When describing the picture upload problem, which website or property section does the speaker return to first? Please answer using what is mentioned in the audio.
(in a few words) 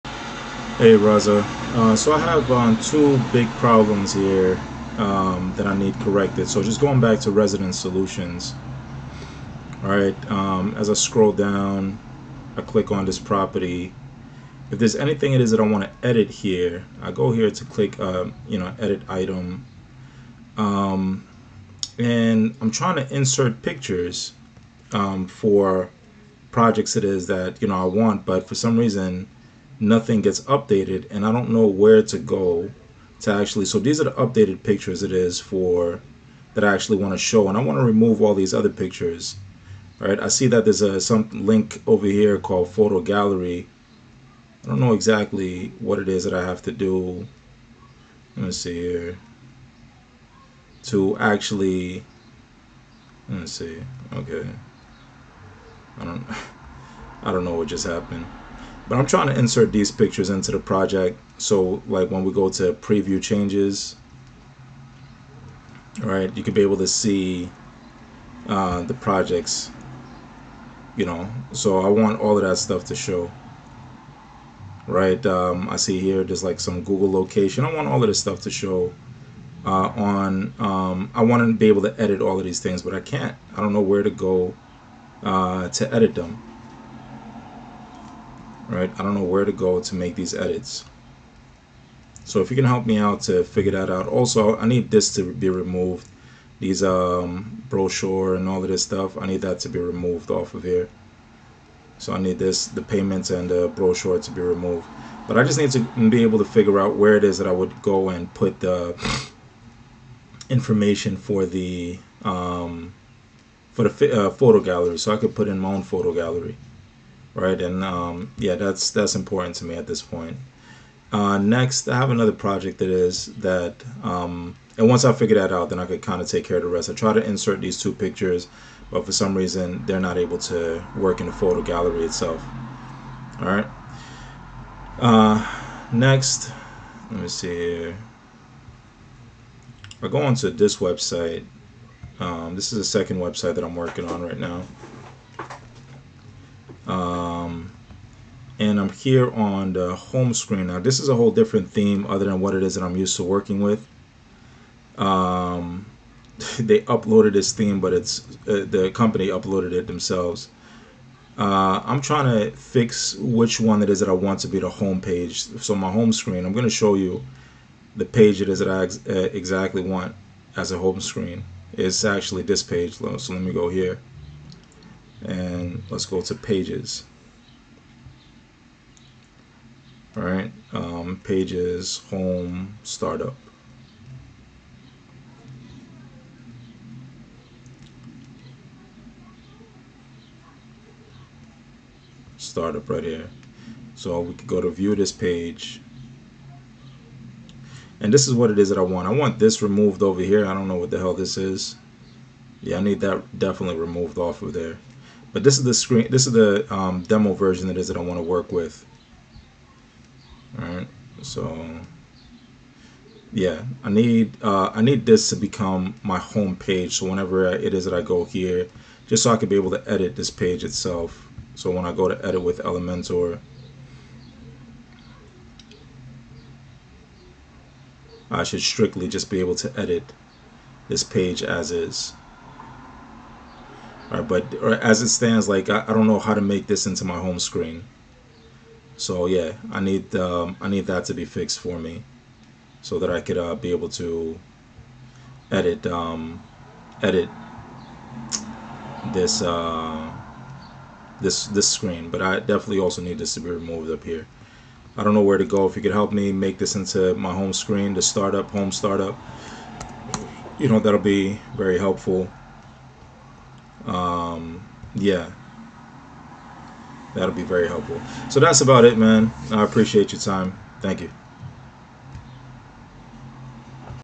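Resident Solutions.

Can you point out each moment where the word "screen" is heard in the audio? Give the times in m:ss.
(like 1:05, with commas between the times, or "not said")
2:30, 2:46, 2:51, 3:25, 3:57, 4:11, 4:17.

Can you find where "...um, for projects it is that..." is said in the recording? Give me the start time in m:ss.
0:24.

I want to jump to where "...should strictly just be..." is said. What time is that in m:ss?
3:48.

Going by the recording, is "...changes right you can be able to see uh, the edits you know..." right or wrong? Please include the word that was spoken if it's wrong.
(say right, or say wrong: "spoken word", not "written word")
wrong: "projects", not "edits".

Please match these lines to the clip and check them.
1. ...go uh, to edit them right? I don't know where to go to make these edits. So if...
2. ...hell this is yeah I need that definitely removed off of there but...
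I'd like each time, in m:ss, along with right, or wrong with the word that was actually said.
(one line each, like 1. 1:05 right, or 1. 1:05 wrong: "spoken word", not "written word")
1. 1:24 right
2. 3:20 right.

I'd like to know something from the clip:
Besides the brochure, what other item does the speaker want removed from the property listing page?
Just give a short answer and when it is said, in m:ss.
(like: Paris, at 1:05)
the payments, at 1:42.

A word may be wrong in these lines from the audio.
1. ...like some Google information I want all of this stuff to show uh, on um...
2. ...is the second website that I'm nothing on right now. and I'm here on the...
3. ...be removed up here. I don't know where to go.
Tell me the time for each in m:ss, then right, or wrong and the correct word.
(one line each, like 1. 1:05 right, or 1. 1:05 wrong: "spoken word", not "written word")
1. 1:16 wrong: "location", not "information"
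2. 2:22 wrong: "working", not "nothing"
3. 4:13 right.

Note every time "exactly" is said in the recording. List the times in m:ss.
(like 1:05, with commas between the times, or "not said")
0:44, 2:49.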